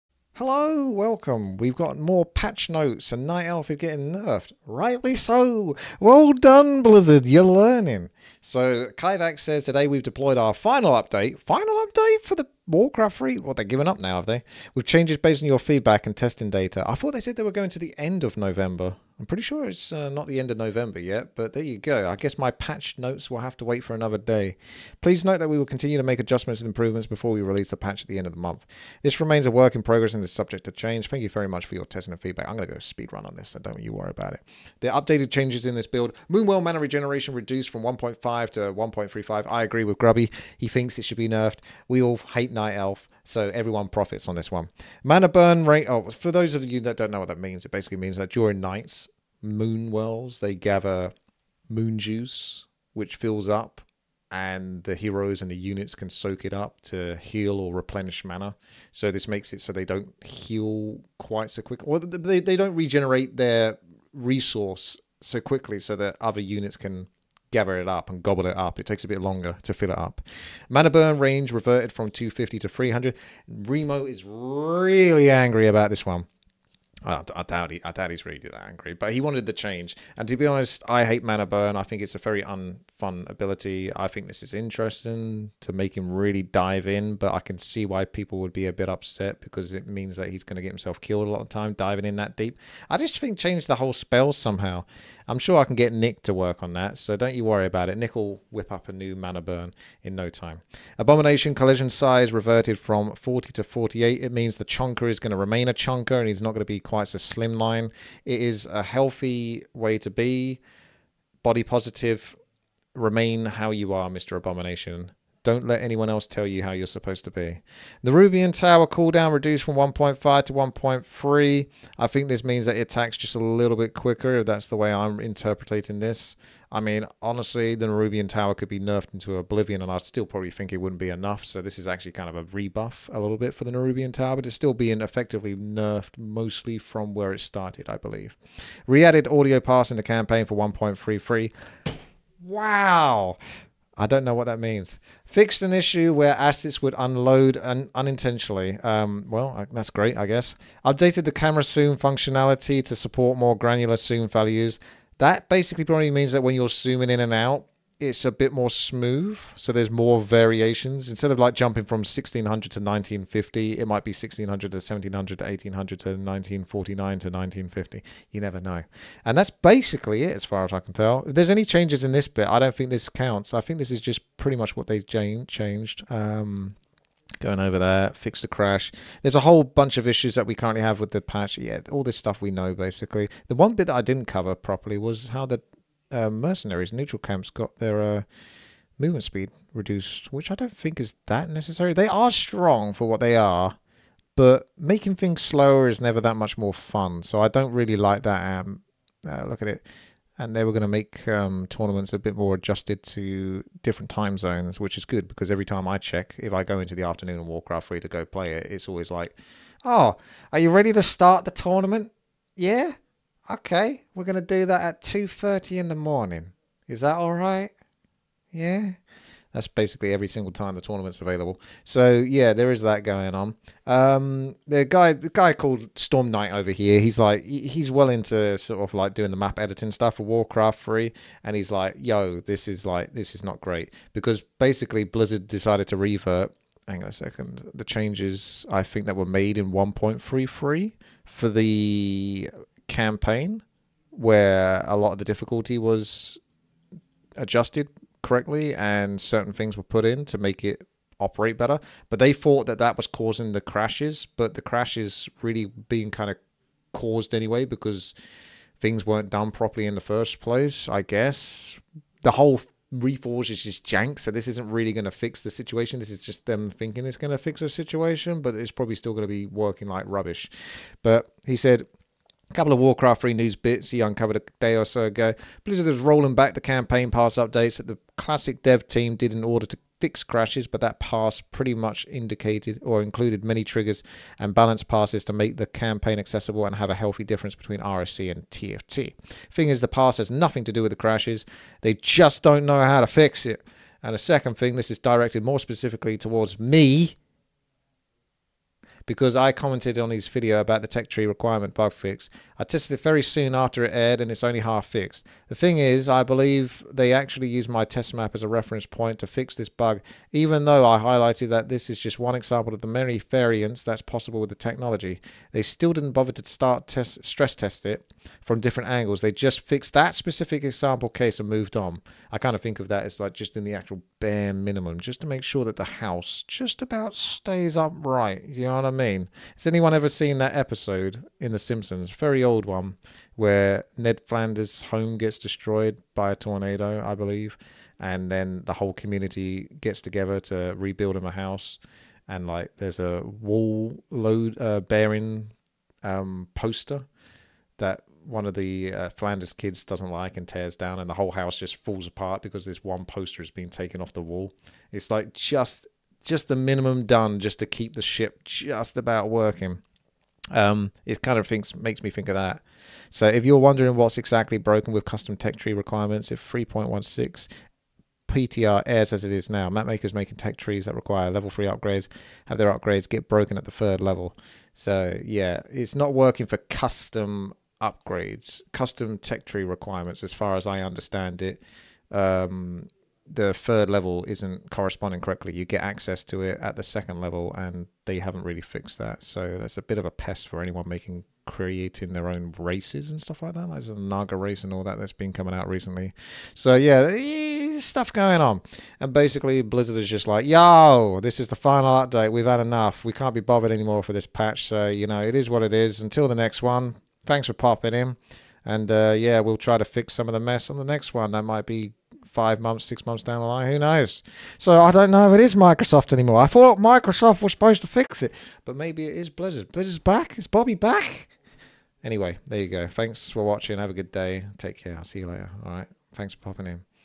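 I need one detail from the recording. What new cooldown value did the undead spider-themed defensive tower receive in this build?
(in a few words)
1.3.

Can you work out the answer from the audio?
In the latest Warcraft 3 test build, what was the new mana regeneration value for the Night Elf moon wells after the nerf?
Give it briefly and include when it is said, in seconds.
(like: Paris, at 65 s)
1.35, at 38 s.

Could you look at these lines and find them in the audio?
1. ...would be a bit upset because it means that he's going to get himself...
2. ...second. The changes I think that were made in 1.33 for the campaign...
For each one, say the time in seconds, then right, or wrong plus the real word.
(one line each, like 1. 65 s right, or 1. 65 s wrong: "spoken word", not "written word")
1. 88 s right
2. 237 s right.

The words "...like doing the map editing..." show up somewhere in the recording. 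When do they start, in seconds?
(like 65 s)
228 s.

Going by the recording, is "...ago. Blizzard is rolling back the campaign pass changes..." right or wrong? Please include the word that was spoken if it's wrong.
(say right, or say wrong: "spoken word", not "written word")
wrong: "updates", not "changes".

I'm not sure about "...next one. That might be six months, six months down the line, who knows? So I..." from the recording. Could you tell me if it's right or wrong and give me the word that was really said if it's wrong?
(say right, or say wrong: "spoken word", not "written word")
wrong: "five", not "six".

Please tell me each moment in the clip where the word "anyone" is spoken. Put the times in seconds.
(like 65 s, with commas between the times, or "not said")
115 s, 329 s, 390 s.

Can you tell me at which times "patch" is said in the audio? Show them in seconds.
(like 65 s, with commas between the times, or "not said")
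2 s, 22 s, 27 s, 181 s, 404 s.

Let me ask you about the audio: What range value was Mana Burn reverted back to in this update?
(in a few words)
300.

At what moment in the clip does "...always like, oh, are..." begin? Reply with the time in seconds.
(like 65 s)
208 s.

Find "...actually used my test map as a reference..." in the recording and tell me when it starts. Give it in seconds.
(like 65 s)
307 s.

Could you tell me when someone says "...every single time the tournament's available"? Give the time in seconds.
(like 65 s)
220 s.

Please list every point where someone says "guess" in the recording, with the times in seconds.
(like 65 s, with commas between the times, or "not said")
22 s, 150 s, 261 s.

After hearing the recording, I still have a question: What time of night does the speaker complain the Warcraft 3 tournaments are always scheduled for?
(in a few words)
2:30 in the morning.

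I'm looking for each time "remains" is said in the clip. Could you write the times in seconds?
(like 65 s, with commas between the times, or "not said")
29 s, 105 s, 112 s.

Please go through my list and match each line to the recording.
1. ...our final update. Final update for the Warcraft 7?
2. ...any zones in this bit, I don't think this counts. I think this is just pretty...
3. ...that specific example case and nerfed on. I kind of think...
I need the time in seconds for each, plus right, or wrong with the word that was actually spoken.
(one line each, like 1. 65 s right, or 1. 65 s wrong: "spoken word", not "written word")
1. 10 s wrong: "3", not "7"
2. 171 s wrong: "changes", not "zones"
3. 319 s wrong: "moved", not "nerfed".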